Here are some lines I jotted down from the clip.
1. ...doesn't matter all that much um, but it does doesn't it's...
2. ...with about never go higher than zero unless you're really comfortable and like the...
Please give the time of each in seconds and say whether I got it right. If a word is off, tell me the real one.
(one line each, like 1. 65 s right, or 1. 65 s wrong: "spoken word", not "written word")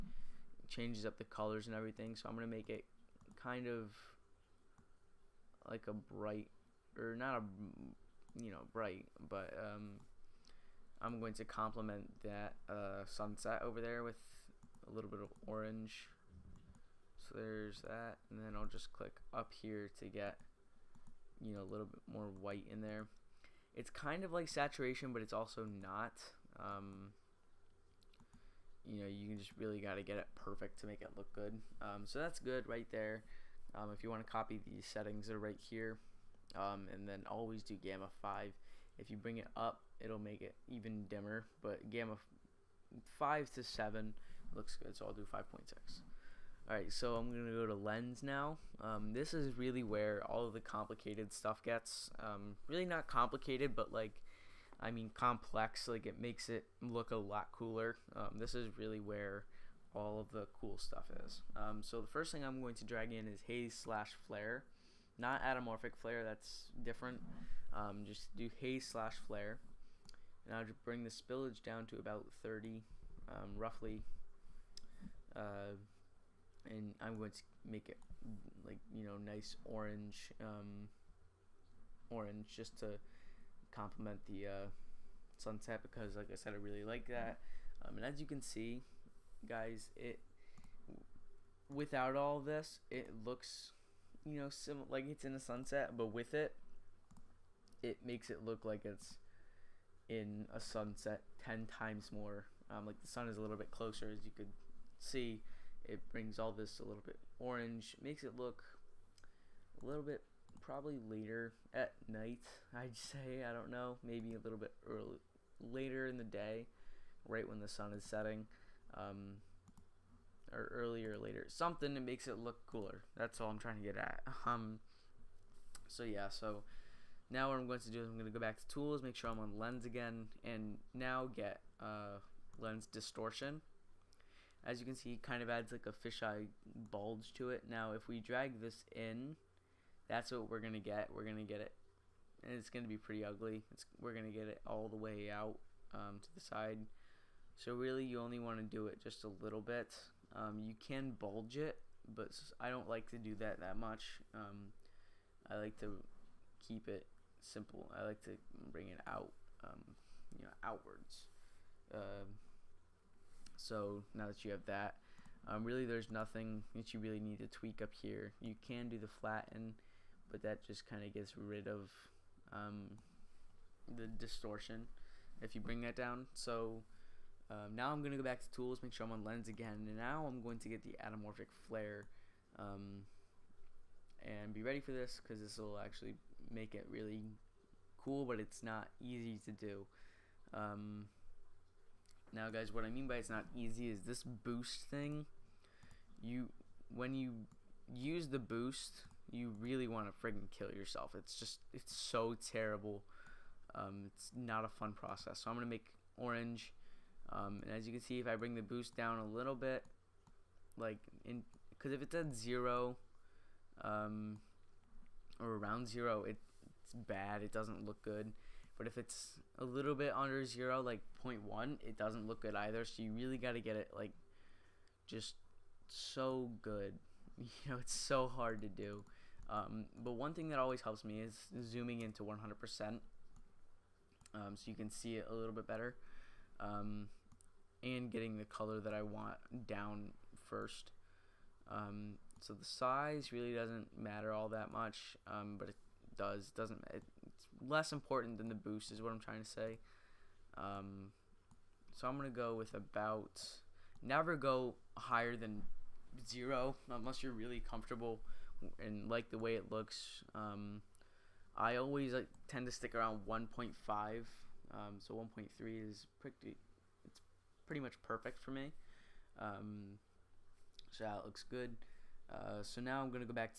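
1. 243 s right
2. 252 s right.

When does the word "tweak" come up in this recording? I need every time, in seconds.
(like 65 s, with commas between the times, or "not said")
167 s.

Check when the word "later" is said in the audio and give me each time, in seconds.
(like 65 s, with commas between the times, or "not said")
111 s, 115 s, 121 s.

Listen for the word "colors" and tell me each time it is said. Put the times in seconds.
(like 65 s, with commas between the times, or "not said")
1 s, 238 s.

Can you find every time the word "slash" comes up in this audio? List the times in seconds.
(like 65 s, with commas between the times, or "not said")
63 s, 68 s.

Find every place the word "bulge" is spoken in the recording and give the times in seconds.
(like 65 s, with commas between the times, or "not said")
136 s, 151 s.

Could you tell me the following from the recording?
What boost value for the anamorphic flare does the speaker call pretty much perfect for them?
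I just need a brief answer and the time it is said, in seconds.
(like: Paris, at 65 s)
1.3, at 265 s.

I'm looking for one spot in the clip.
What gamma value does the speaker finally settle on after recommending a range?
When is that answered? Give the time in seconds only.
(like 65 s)
45 s.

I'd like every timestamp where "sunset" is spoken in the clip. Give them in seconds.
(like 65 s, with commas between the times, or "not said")
13 s, 85 s, 95 s, 100 s.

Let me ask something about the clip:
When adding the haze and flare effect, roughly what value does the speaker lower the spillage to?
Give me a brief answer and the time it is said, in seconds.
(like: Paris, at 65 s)
30, at 72 s.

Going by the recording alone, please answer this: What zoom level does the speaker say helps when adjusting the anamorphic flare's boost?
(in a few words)
100%.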